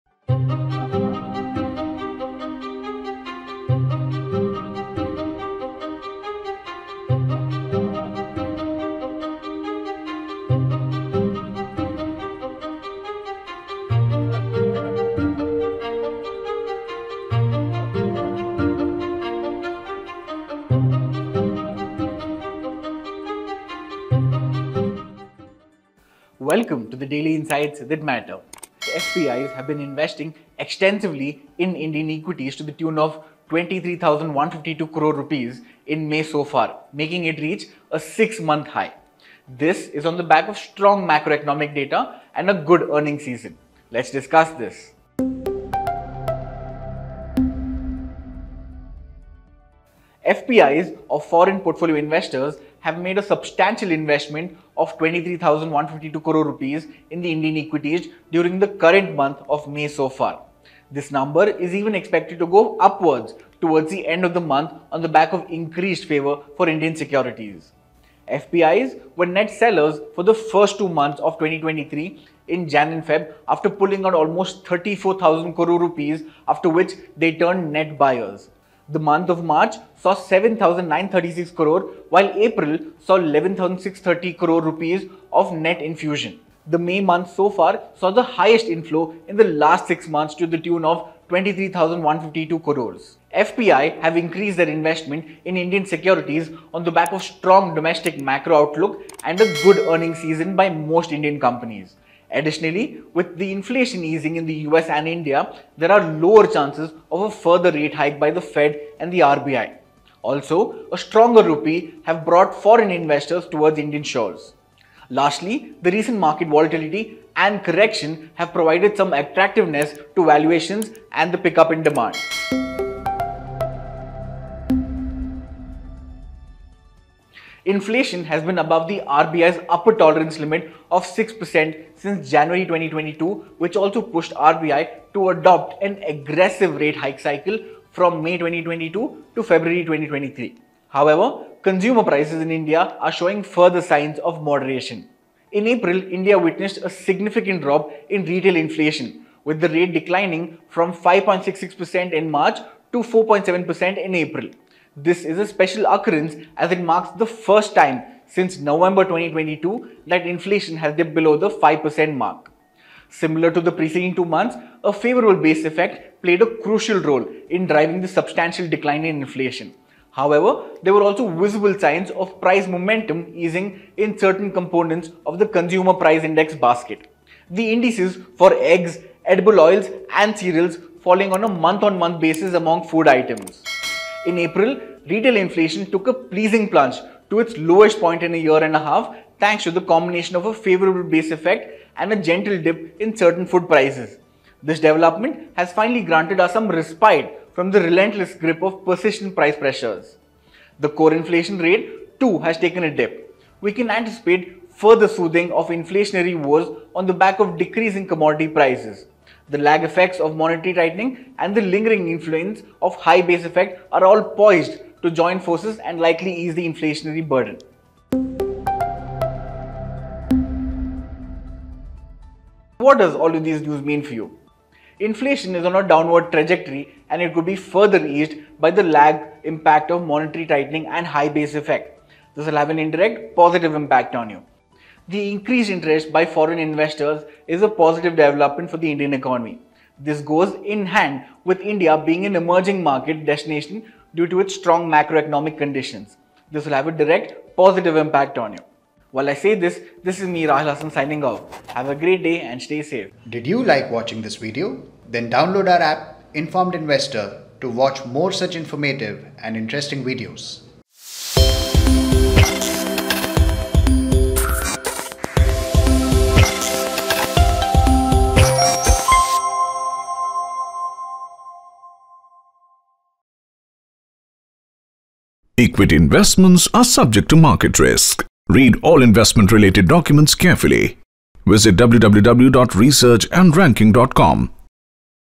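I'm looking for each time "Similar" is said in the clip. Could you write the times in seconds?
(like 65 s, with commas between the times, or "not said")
163 s.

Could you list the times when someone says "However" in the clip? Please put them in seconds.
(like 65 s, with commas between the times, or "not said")
140 s, 170 s.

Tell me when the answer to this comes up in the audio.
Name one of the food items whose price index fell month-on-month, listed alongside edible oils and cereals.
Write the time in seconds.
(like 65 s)
178 s.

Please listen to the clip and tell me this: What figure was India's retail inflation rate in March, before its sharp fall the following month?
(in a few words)
5.66%.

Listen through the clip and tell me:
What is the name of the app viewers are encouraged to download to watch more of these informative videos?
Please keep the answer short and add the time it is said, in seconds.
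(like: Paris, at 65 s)
Informed InvestoRR, at 256 s.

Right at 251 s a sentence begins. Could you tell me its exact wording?
Have a great day and stay safe.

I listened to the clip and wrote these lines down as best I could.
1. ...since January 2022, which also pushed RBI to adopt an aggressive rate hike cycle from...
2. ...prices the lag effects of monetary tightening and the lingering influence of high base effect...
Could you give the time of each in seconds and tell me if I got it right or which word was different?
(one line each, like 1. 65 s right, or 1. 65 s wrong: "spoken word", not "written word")
1. 131 s right
2. 208 s right.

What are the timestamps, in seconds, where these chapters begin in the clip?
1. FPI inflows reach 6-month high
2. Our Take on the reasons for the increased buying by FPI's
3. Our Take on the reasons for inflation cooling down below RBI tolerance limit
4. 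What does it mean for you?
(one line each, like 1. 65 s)
1. 28 s
2. 93 s
3. 185 s
4. 220 s.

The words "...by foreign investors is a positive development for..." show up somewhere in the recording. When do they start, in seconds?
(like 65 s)
236 s.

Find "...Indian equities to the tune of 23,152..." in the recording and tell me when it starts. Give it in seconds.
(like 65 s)
31 s.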